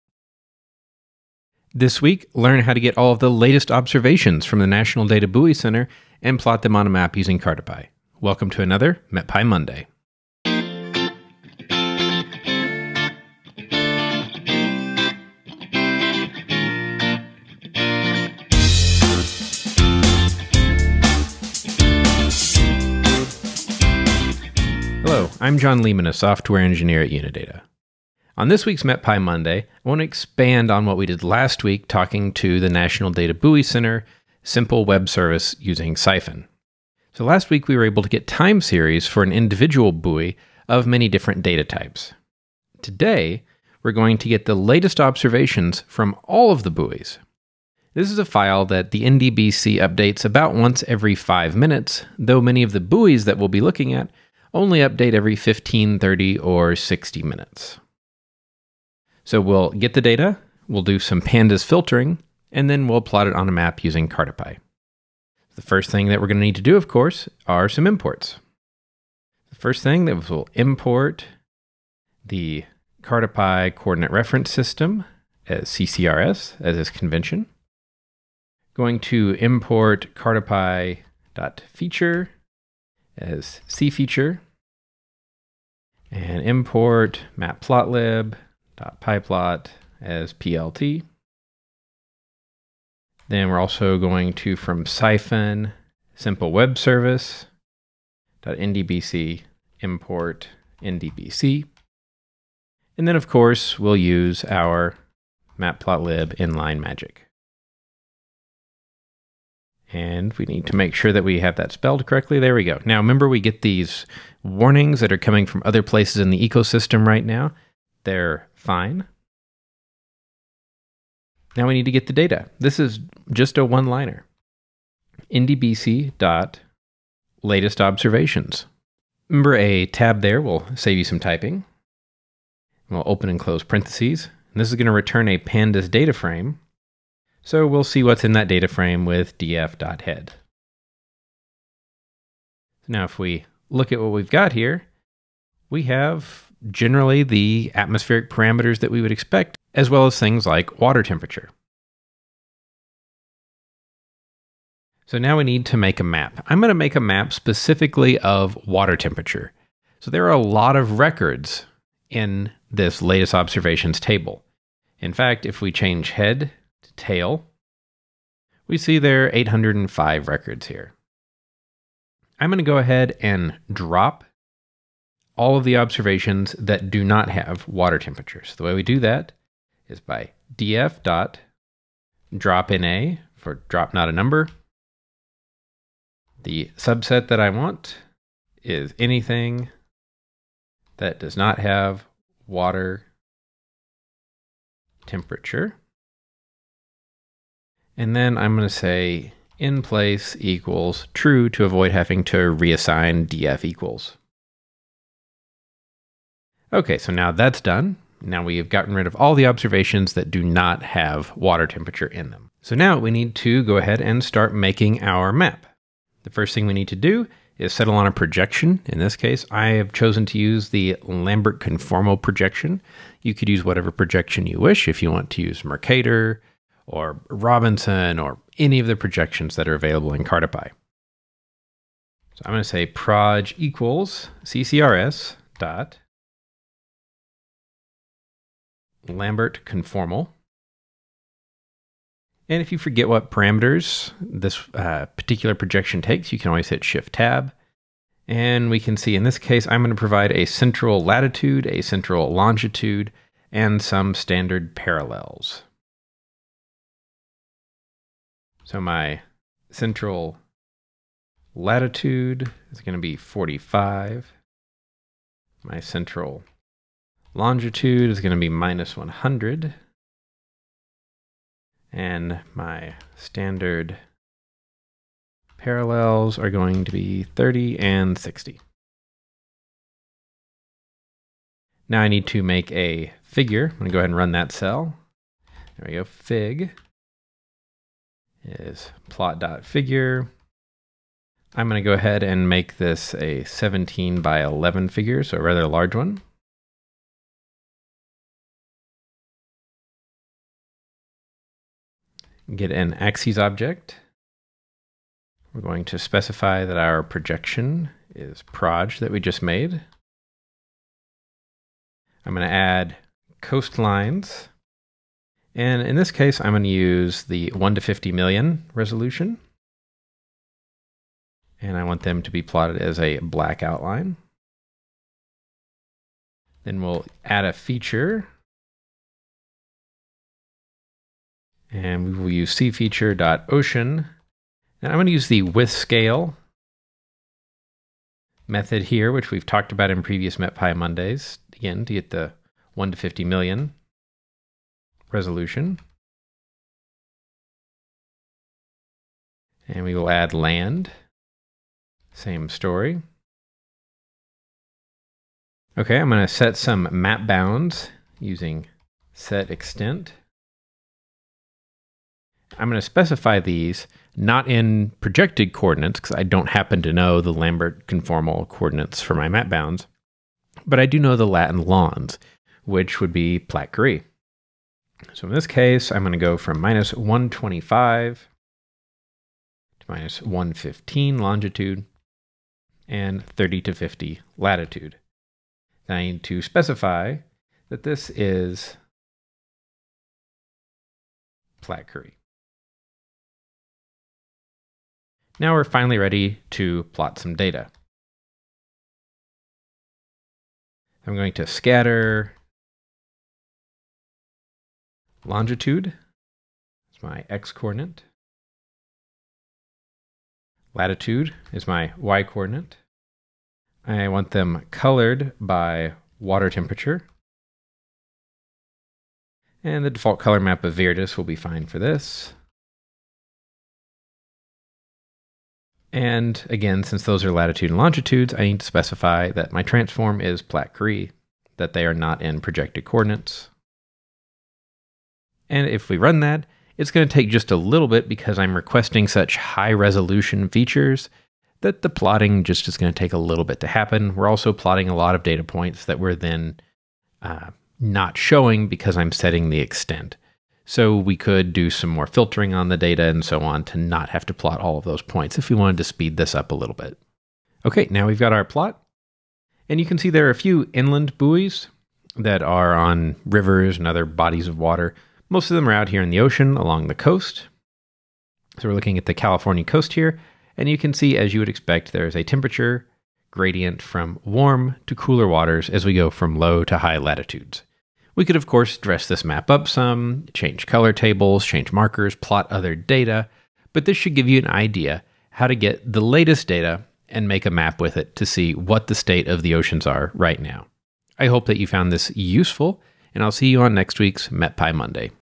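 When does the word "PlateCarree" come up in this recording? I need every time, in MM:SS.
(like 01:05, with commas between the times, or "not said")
06:13, 06:31, 07:10.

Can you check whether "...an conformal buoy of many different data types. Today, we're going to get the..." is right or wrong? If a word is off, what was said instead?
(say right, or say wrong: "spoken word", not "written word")
wrong: "individual", not "conformal".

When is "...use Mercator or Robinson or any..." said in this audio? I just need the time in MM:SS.
03:45.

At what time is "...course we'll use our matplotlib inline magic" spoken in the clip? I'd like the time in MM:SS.
01:43.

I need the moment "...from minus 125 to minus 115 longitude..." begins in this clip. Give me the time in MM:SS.
06:16.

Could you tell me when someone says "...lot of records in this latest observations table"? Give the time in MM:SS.
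02:40.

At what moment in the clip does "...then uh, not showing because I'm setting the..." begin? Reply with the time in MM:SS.
07:26.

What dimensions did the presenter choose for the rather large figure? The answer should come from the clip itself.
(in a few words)
17 by 11.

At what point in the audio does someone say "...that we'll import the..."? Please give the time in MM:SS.
01:10.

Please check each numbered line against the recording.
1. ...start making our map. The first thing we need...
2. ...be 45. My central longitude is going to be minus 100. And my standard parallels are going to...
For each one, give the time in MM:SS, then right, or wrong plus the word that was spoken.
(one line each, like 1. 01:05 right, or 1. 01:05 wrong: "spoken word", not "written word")
1. 03:34 right
2. 04:23 right.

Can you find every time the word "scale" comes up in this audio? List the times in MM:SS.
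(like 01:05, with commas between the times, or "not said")
05:35.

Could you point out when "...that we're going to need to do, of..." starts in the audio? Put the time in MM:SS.
01:06.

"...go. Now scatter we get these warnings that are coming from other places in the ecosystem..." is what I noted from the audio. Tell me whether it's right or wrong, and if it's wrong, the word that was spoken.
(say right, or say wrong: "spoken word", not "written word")
wrong: "remember", not "scatter".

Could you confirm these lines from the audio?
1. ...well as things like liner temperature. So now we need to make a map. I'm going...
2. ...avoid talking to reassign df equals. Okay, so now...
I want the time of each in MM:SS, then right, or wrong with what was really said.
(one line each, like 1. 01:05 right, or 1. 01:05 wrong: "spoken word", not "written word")
1. 02:29 wrong: "water", not "liner"
2. 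03:21 wrong: "having", not "talking".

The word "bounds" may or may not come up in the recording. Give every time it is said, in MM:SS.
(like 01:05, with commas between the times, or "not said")
05:57, 06:09.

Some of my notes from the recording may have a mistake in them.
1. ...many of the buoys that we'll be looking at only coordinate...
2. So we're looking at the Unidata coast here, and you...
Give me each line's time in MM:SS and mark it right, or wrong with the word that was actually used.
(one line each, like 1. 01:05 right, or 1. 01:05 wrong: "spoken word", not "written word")
1. 00:52 wrong: "update", not "coordinate"
2. 07:48 wrong: "California", not "Unidata".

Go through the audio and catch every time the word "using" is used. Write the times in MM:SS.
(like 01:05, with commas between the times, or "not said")
00:07, 00:35, 01:03, 05:58.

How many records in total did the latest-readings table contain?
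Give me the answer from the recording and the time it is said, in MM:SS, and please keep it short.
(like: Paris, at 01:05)
805, at 02:49.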